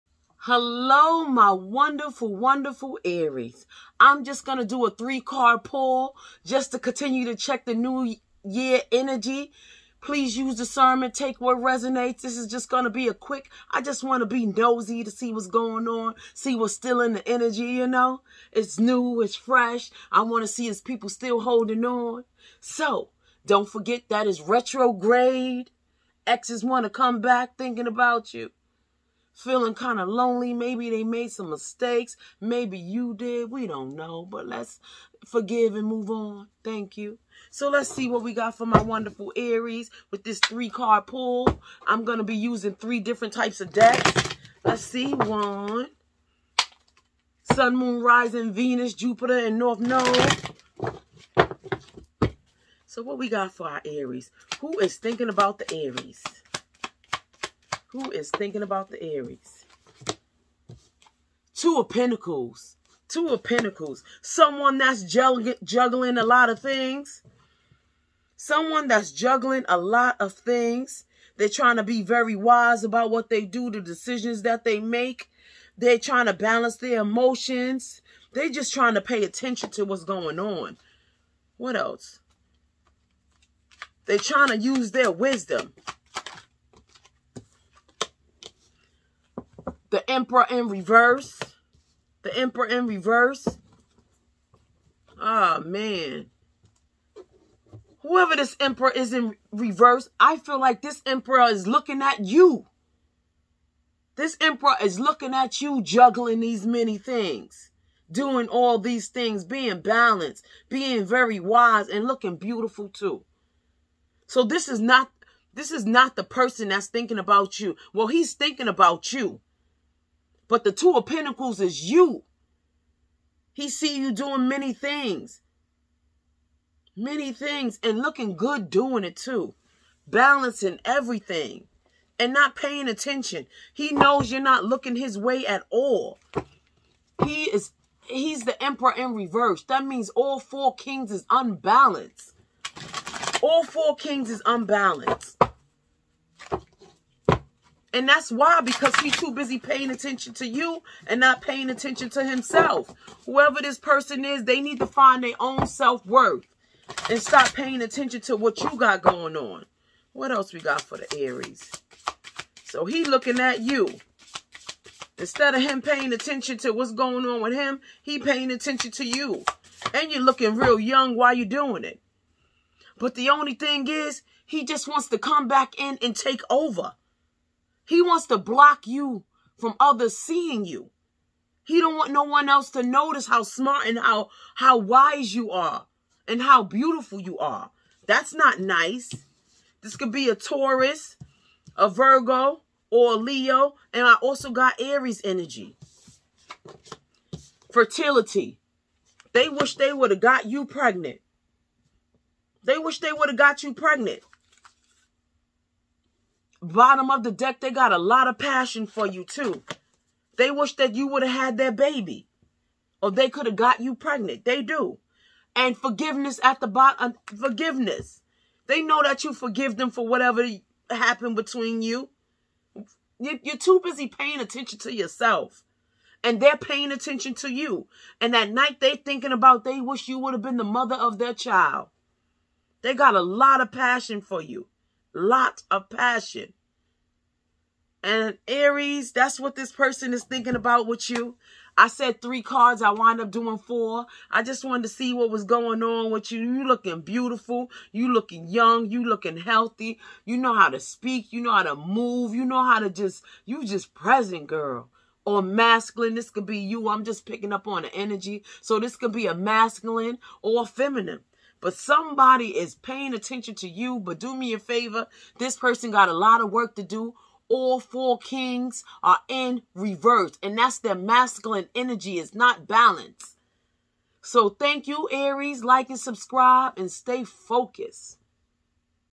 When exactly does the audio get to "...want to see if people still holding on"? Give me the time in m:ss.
0:20.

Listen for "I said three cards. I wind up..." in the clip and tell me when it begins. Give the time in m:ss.
4:01.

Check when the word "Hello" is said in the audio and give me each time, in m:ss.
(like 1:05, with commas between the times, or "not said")
0:00.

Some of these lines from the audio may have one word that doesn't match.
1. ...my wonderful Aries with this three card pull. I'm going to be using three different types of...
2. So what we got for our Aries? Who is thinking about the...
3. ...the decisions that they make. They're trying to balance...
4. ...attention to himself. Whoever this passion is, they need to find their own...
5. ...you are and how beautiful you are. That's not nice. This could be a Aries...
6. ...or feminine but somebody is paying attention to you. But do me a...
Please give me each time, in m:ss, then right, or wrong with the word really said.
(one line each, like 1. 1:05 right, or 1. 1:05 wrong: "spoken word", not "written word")
1. 0:38 right
2. 0:52 right
3. 1:13 right
4. 2:31 wrong: "person", not "passion"
5. 3:05 wrong: "Taurus", not "Aries"
6. 4:20 right.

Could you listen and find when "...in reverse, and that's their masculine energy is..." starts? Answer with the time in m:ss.
4:29.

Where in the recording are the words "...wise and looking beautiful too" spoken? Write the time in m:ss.
1:51.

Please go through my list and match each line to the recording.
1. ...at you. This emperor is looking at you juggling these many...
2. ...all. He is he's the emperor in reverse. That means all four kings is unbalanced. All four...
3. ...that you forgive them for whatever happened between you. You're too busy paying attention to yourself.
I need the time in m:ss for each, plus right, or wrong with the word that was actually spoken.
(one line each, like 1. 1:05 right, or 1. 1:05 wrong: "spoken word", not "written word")
1. 1:42 right
2. 2:15 right
3. 3:39 right.